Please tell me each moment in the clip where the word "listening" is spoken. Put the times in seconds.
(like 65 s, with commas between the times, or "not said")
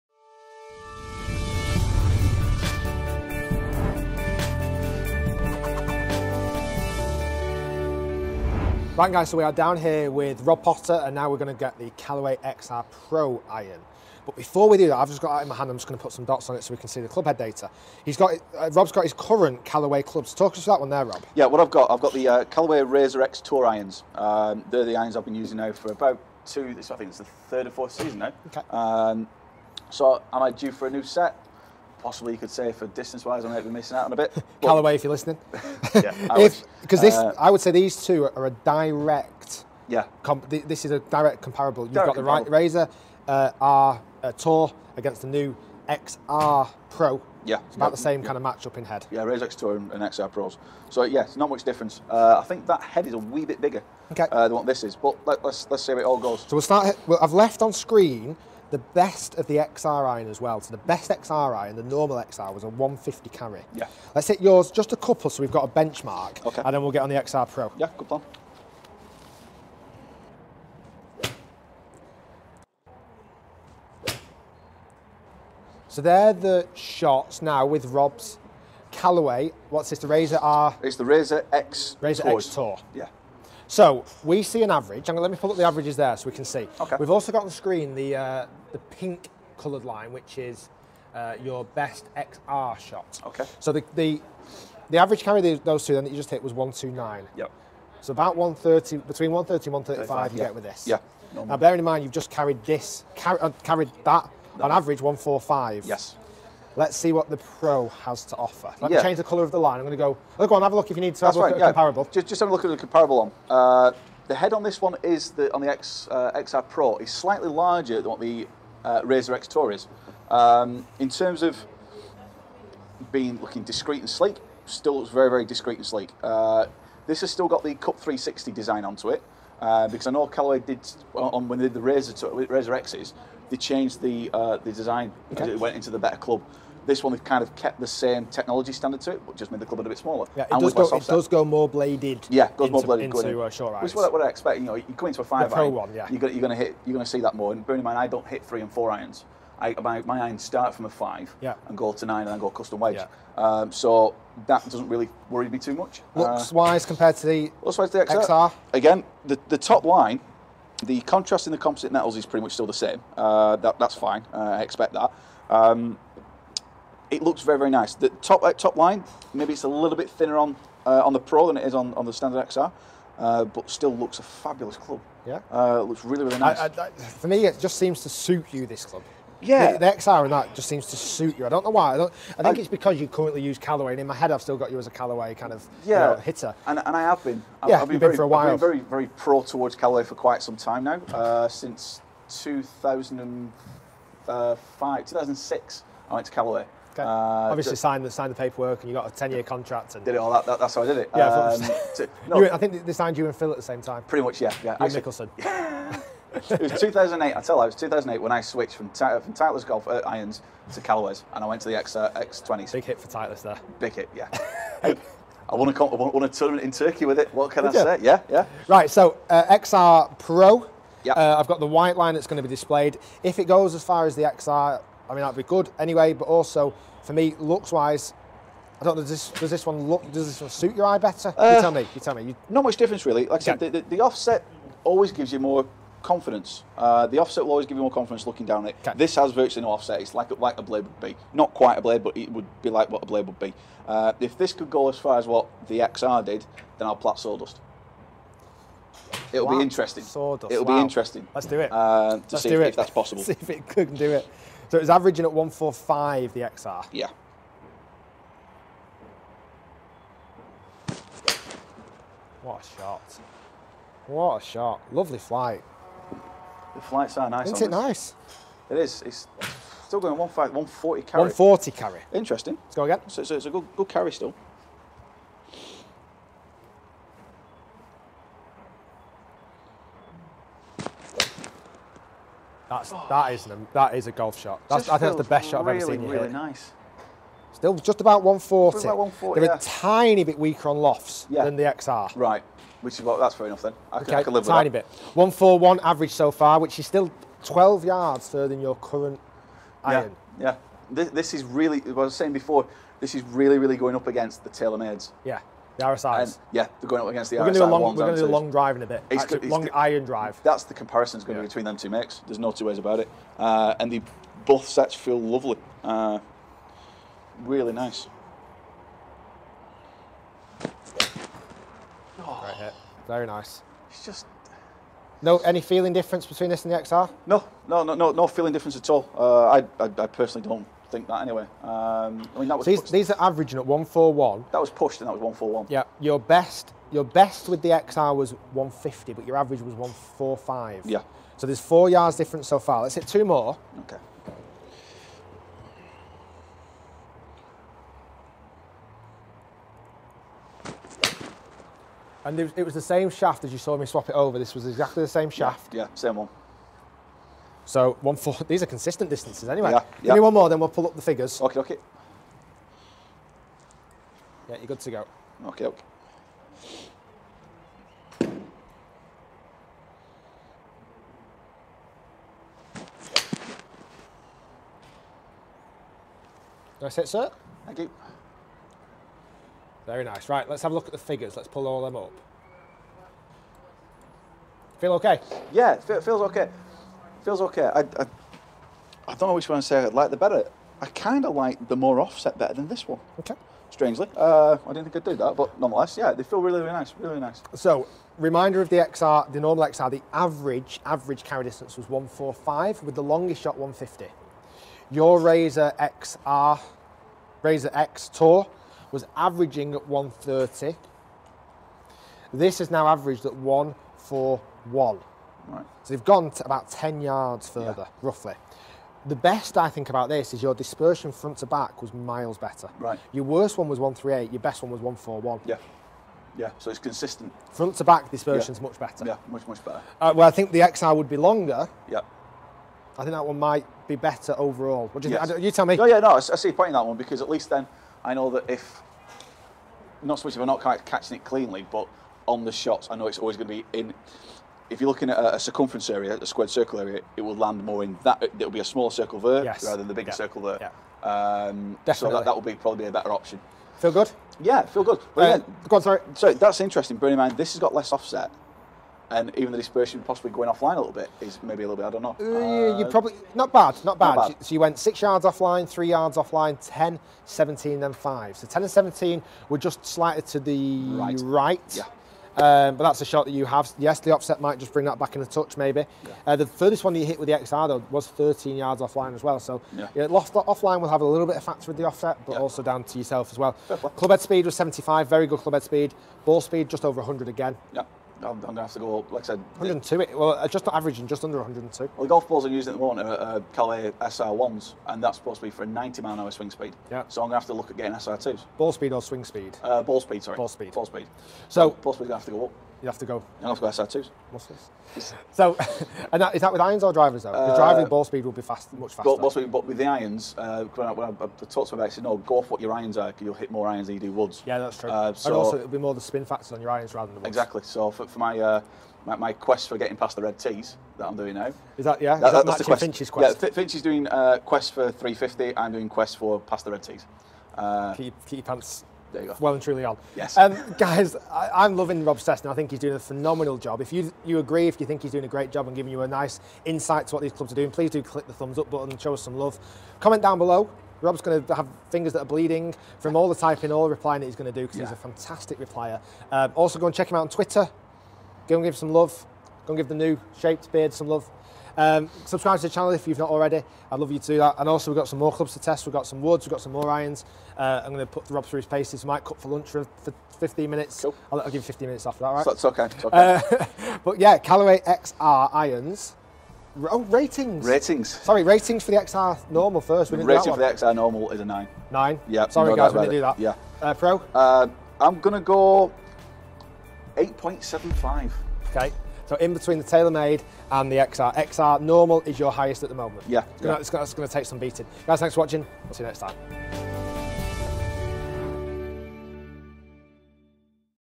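35 s.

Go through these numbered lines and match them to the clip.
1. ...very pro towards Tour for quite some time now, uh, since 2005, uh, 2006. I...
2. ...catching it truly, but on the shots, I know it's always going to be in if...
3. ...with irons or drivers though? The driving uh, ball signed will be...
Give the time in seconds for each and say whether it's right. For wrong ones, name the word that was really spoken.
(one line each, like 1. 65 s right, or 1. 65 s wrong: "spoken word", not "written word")
1. 188 s wrong: "Callaway", not "Tour"
2. 440 s wrong: "cleanly", not "truly"
3. 506 s wrong: "speed", not "signed".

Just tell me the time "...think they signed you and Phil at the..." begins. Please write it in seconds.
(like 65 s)
202 s.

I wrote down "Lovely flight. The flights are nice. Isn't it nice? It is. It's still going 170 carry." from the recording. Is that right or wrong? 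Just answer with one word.
wrong.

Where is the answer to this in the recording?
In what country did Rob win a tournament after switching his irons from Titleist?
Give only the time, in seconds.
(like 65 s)
216 s.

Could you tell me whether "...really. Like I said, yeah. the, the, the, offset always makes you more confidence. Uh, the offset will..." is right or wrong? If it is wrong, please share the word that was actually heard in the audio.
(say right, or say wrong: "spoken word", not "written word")
wrong: "gives", not "makes".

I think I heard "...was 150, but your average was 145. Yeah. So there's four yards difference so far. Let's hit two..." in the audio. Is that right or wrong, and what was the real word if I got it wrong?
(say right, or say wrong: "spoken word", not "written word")
right.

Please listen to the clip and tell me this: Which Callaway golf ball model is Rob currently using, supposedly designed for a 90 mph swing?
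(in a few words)
SR1.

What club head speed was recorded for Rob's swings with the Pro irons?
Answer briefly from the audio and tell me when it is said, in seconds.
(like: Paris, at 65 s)
75, at 484 s.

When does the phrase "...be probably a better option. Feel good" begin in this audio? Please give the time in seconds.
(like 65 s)
452 s.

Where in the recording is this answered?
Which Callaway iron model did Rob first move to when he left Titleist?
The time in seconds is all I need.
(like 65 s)
212 s.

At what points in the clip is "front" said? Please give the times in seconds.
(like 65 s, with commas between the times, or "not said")
421 s, 427 s.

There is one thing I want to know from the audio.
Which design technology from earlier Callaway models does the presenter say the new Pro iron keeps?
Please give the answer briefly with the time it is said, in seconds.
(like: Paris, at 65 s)
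Cup 360, at 127 s.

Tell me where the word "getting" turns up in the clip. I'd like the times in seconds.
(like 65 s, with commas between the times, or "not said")
497 s, 519 s.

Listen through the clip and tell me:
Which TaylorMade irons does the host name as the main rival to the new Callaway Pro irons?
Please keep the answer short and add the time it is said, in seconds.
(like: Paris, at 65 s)
RSI, at 305 s.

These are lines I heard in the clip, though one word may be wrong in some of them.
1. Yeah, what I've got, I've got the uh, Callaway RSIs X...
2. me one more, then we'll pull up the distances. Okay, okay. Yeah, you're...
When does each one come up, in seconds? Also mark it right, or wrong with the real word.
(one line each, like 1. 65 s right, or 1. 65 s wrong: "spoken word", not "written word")
1. 21 s wrong: "RAZR", not "RSIs"
2. 360 s wrong: "figures", not "distances".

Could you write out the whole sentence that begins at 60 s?
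So the best XR iron, the normal XR, was a 150 carry.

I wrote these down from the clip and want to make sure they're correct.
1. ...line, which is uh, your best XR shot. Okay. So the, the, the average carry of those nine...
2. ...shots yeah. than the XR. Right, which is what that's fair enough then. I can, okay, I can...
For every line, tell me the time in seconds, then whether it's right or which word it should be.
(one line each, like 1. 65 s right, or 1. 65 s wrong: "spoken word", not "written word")
1. 89 s wrong: "two", not "nine"
2. 290 s wrong: "lofts", not "shots".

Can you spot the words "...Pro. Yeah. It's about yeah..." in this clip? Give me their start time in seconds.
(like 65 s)
46 s.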